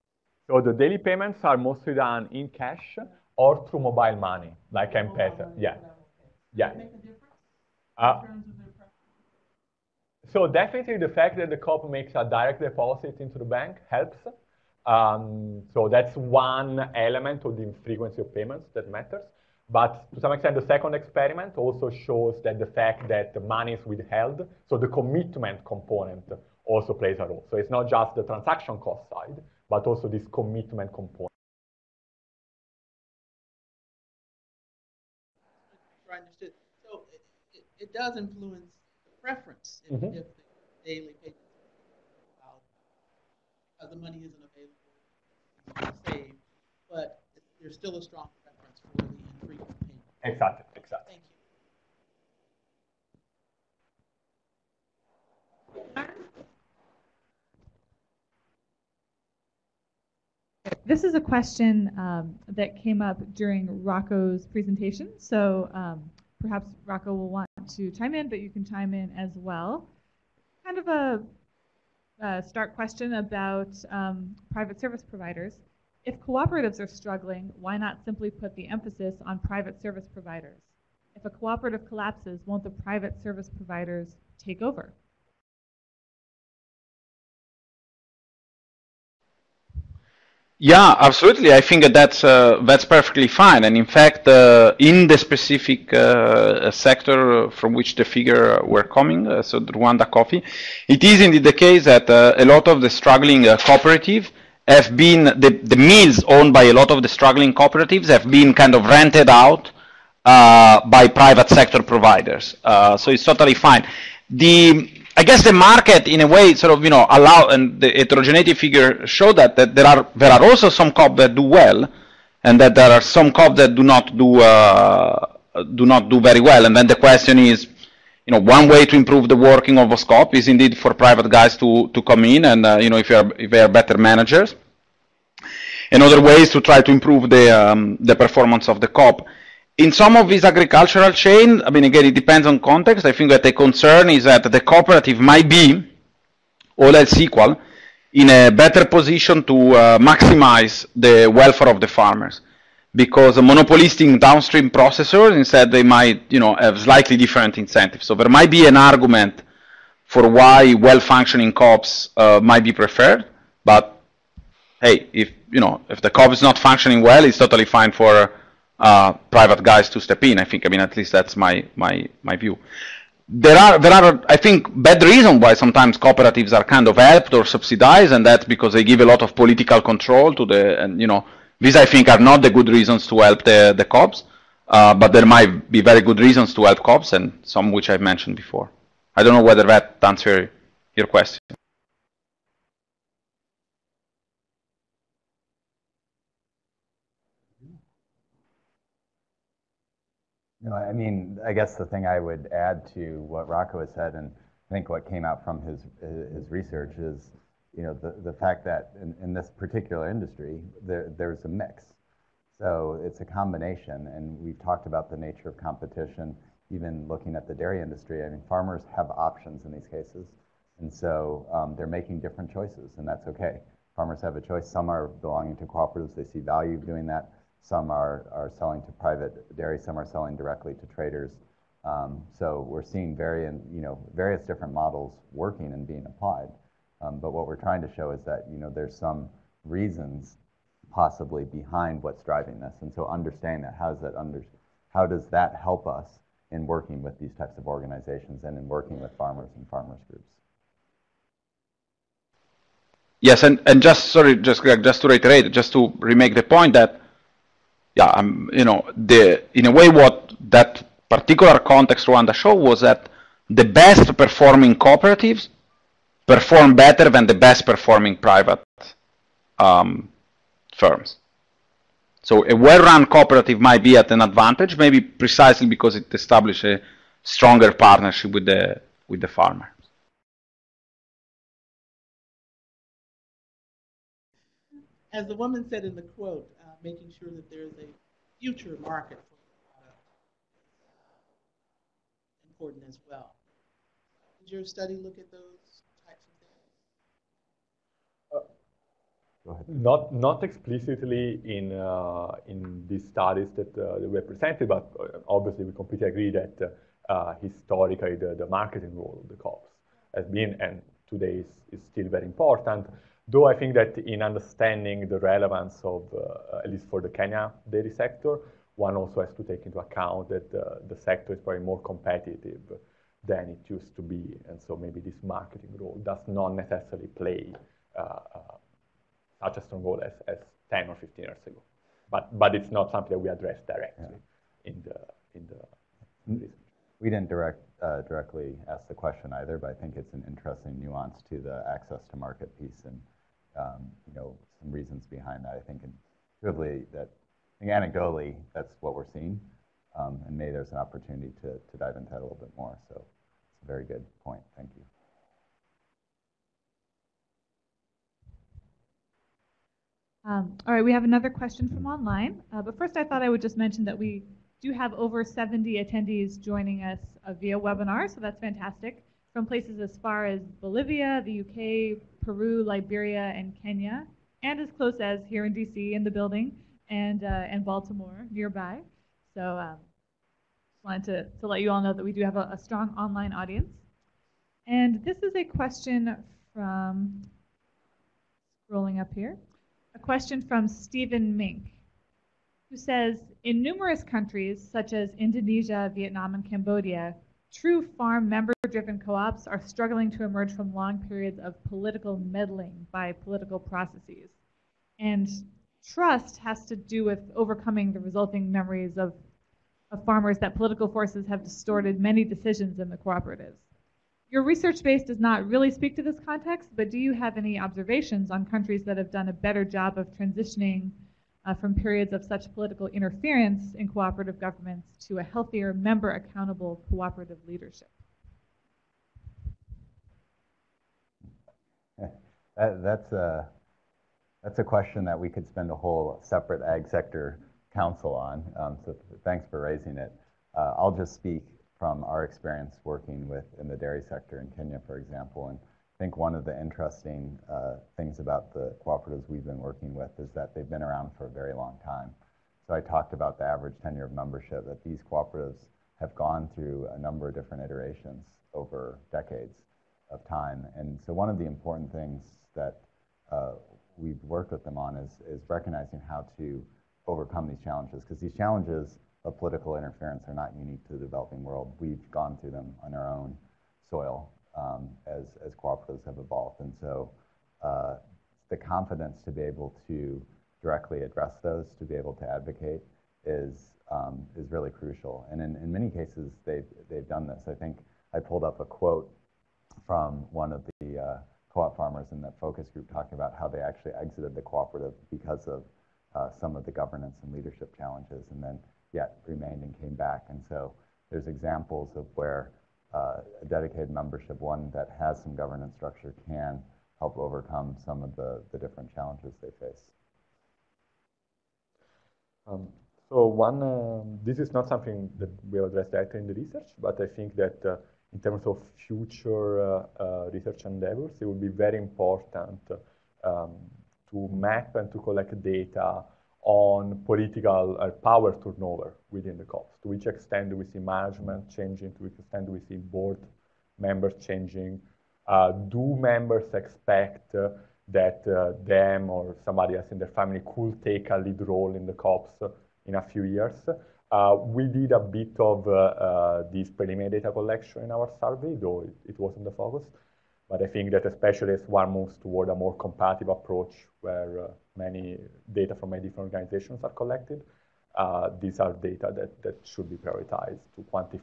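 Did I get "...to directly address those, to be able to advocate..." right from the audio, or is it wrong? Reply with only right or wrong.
right.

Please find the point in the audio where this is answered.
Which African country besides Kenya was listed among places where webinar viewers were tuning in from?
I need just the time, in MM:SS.
06:12.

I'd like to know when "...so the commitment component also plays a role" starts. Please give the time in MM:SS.
00:24.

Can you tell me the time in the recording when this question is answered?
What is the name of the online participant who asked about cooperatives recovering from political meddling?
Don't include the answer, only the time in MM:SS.
06:30.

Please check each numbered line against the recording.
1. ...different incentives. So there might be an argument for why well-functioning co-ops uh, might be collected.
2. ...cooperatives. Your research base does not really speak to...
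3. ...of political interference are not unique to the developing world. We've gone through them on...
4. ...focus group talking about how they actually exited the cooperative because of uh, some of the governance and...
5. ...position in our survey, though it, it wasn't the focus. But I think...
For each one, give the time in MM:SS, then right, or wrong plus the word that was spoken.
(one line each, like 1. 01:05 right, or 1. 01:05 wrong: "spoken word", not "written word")
1. 02:37 wrong: "preferred", not "collected"
2. 06:52 right
3. 07:49 right
4. 08:12 right
5. 09:07 wrong: "collection", not "position".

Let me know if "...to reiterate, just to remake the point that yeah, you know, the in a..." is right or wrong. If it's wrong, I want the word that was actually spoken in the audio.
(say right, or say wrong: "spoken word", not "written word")
right.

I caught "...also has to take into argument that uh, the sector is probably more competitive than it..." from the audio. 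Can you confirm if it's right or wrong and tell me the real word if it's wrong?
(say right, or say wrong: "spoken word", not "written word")
wrong: "account", not "argument".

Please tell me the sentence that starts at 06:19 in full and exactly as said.
So um, just wanted to, to let you all know that we do have a, a strong online audience.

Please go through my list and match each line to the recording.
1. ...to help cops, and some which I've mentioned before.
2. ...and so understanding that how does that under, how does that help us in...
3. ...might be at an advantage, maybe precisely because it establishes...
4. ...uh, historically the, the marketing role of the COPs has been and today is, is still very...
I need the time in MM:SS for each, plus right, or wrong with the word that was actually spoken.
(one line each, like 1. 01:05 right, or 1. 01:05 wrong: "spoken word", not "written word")
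1. 03:06 right
2. 04:02 right
3. 04:33 right
4. 05:07 right.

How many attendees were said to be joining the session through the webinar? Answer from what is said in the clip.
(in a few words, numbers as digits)
over 70.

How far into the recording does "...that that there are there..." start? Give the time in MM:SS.
01:59.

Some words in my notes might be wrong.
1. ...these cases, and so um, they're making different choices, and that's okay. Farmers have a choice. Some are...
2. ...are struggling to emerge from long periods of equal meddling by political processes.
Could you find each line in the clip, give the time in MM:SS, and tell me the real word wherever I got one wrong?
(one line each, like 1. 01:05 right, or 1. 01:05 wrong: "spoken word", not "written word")
1. 03:39 right
2. 06:39 wrong: "political", not "equal".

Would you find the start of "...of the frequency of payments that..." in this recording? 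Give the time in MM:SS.
00:17.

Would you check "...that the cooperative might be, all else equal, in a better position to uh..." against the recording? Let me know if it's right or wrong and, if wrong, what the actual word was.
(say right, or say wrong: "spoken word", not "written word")
right.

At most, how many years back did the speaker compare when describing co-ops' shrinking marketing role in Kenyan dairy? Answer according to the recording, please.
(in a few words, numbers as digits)
15.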